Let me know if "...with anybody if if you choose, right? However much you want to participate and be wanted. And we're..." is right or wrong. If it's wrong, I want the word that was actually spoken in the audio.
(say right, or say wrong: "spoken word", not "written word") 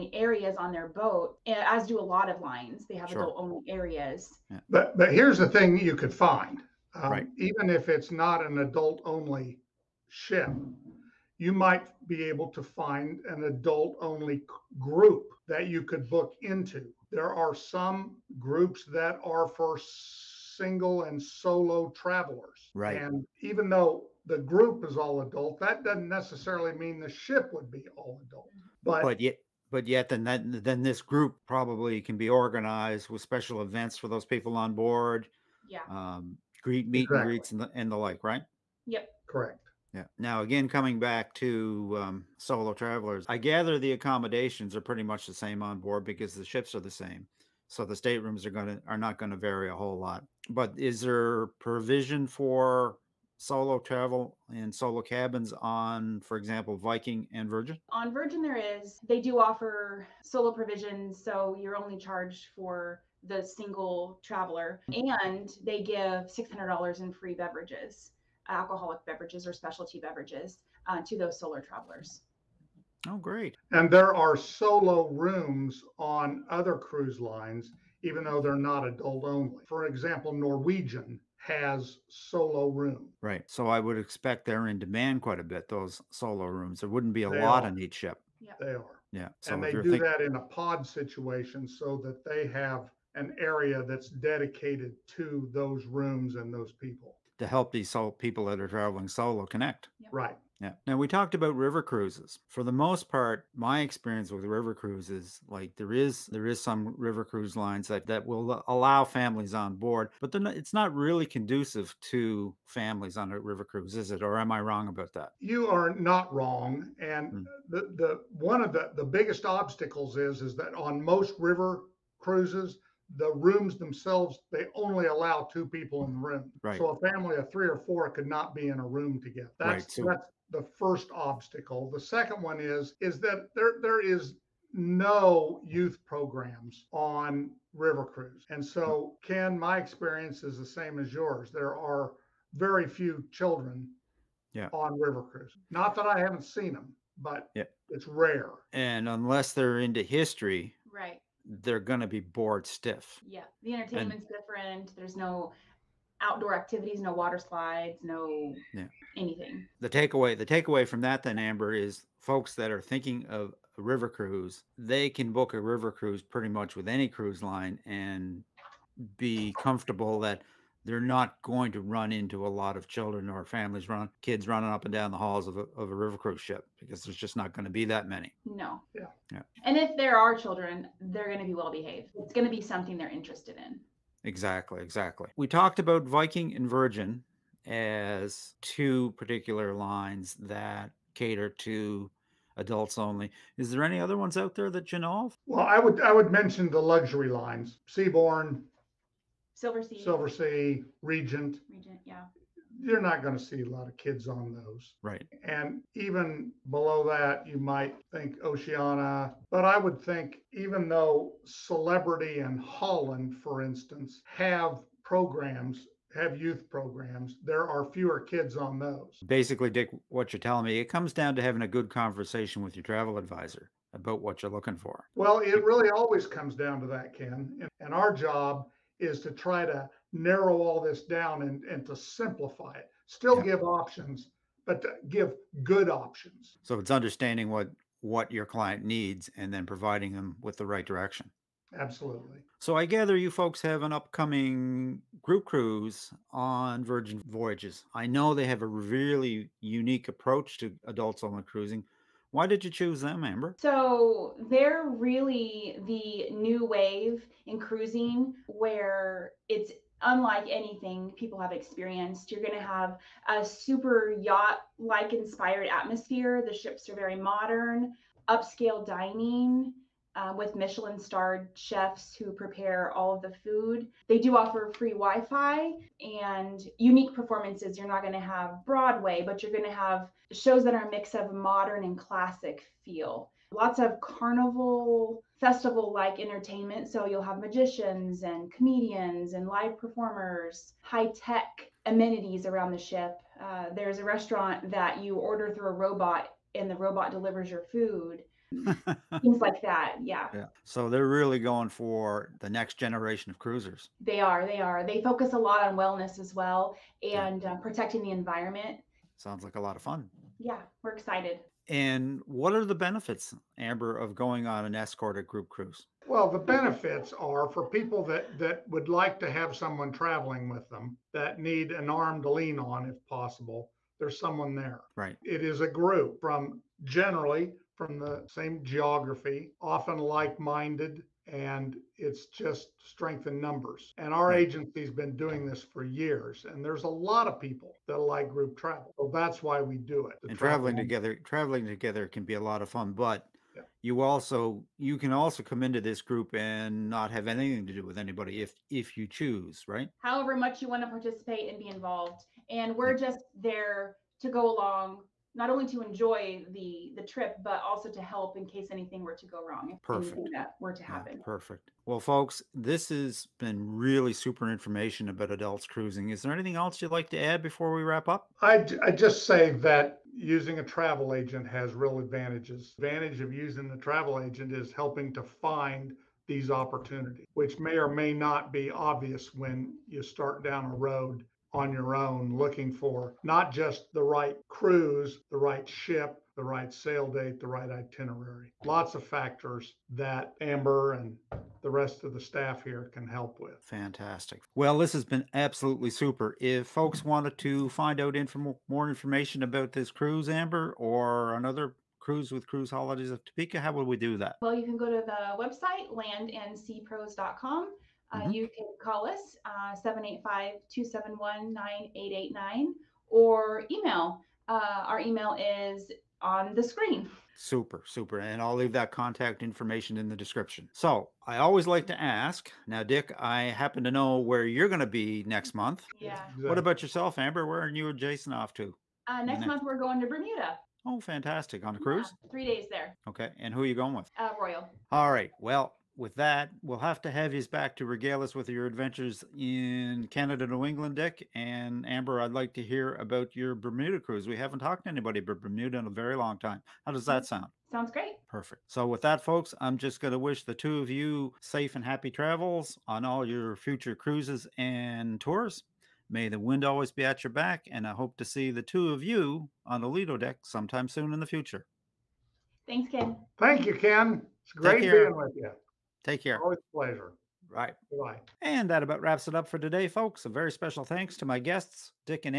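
wrong: "involved", not "wanted".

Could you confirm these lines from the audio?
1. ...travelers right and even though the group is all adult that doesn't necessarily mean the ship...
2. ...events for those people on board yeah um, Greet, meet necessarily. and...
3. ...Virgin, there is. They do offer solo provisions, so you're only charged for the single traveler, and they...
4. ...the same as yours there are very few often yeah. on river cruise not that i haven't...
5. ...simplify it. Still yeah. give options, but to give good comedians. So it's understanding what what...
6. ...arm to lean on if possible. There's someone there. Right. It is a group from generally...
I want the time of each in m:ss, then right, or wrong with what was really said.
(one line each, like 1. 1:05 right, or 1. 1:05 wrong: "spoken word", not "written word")
1. 0:21 right
2. 0:33 wrong: "exactly", not "necessarily"
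3. 0:58 right
4. 2:20 wrong: "children", not "often"
5. 3:51 wrong: "options", not "comedians"
6. 5:21 right.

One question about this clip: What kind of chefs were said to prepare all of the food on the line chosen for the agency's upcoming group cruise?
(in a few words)
Michelin starred chefs.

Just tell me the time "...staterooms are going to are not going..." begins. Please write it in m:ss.
0:47.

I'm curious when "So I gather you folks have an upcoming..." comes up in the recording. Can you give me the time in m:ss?
4:02.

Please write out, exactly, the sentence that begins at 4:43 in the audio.
Lots of carnival festival like entertainment.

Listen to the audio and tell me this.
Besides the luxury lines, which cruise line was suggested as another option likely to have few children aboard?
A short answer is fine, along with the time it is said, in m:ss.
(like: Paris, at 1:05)
Oceania, at 3:28.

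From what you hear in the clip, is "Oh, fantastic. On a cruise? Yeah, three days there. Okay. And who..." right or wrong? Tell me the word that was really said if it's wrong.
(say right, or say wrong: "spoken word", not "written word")
right.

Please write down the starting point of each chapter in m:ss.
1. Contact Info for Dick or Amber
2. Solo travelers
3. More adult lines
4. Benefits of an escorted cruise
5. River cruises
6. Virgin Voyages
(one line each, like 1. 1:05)
1. 6:37
2. 0:44
3. 3:16
4. 5:15
5. 1:42
6. 4:22.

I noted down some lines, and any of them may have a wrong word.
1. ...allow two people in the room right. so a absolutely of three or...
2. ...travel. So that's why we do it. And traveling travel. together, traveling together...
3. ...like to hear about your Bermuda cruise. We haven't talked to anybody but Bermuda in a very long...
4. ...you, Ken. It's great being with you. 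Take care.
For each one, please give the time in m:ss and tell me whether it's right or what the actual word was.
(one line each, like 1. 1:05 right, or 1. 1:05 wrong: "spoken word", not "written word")
1. 2:05 wrong: "family", not "absolutely"
2. 5:38 right
3. 7:22 right
4. 7:43 right.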